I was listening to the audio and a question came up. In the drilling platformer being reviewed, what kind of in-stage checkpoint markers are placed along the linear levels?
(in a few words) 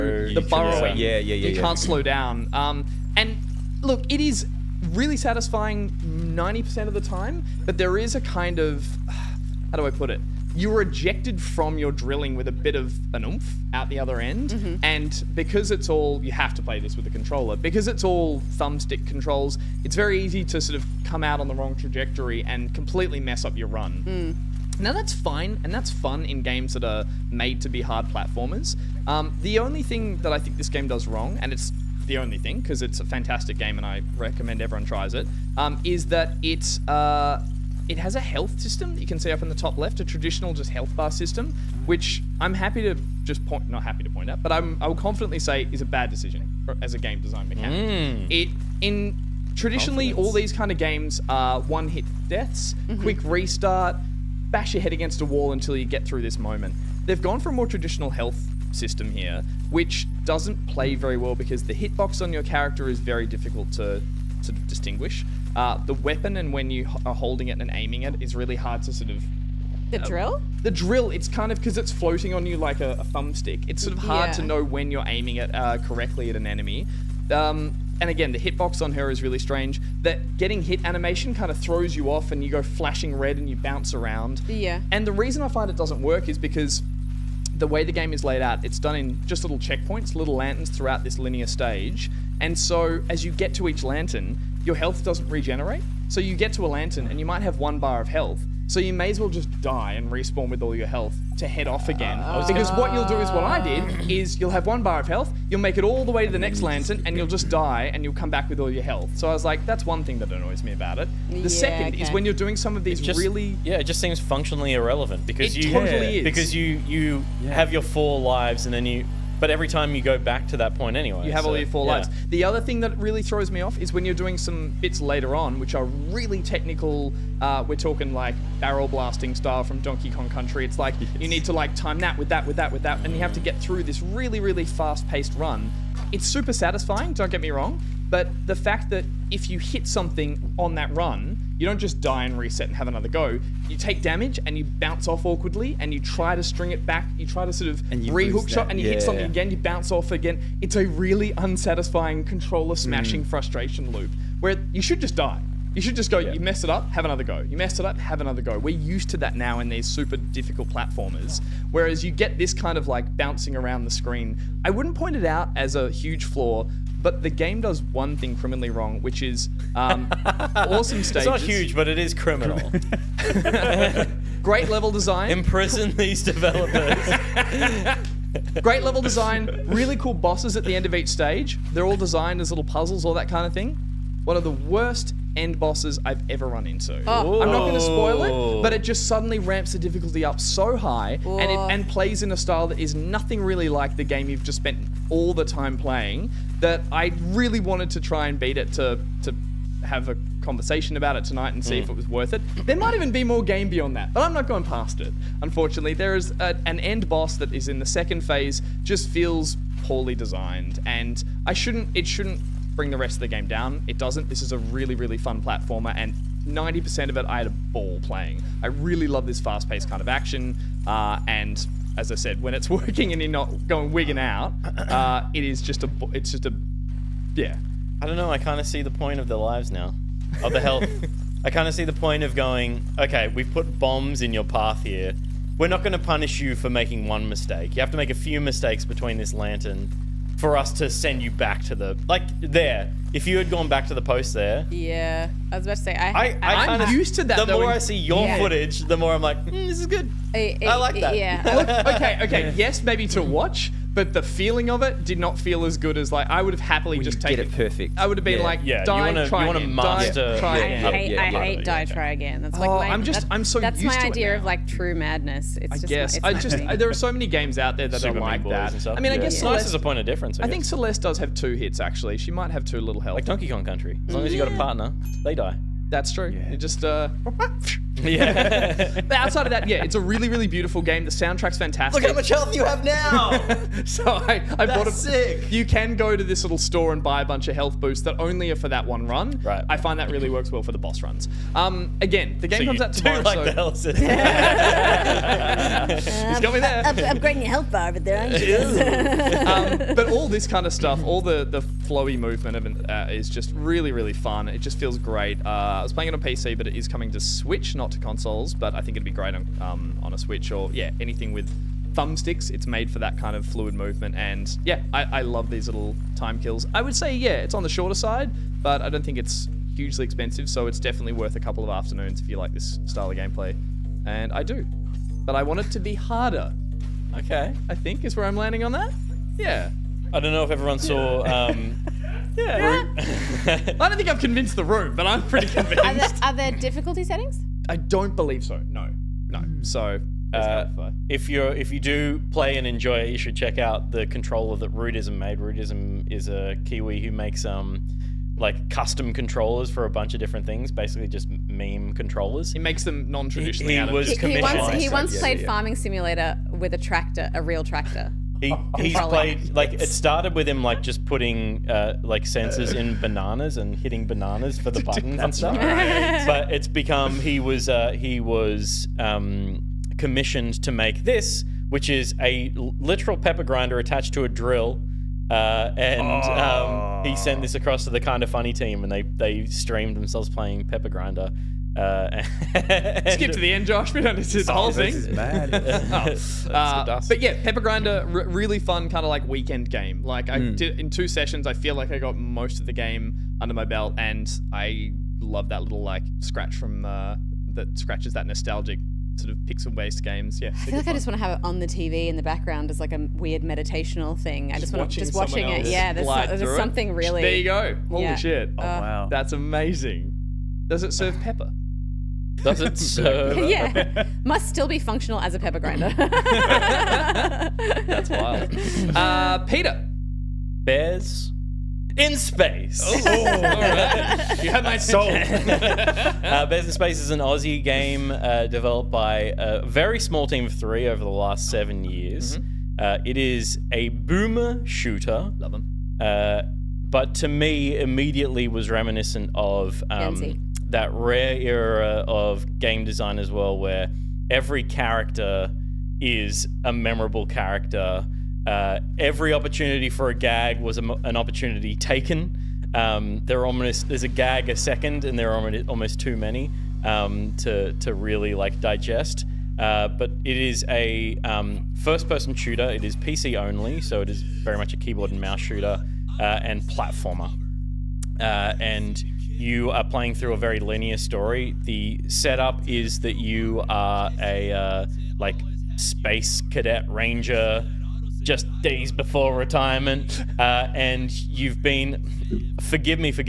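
Lanterns.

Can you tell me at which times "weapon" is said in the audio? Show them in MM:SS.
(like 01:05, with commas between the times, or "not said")
01:05.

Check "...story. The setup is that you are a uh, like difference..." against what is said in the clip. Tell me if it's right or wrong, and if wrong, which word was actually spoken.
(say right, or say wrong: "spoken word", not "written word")
wrong: "space", not "difference".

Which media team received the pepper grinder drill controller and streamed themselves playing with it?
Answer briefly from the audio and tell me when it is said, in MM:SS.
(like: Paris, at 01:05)
Kinda Funny, at 06:17.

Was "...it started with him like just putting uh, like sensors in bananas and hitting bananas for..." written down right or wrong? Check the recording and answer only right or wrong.
right.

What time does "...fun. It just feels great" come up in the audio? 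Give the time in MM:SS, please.
05:04.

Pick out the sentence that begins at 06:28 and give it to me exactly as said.
really fun kind of like weekend game.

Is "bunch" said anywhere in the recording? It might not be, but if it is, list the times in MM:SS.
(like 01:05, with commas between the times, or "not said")
04:47, 05:49.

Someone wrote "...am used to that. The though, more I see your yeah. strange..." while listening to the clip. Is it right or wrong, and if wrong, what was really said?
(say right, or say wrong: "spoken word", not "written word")
wrong: "footage", not "strange".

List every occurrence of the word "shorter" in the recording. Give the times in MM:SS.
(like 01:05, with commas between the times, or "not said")
05:17.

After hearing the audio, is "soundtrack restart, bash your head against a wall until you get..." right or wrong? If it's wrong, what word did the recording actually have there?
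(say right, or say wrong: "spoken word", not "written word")
wrong: "quick", not "soundtrack".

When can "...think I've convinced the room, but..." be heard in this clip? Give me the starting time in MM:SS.
05:33.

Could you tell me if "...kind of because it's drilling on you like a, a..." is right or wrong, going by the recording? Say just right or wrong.
wrong.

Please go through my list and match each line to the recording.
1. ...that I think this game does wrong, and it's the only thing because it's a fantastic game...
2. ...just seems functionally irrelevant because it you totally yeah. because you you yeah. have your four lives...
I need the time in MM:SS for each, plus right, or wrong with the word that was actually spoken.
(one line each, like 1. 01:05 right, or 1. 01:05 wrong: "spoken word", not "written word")
1. 00:30 right
2. 01:53 right.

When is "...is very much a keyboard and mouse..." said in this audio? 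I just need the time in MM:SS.
07:44.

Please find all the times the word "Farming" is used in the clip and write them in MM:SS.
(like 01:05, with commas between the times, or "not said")
05:55.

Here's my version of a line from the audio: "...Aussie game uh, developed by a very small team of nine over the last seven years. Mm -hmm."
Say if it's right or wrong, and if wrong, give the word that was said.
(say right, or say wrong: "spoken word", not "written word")
wrong: "three", not "nine".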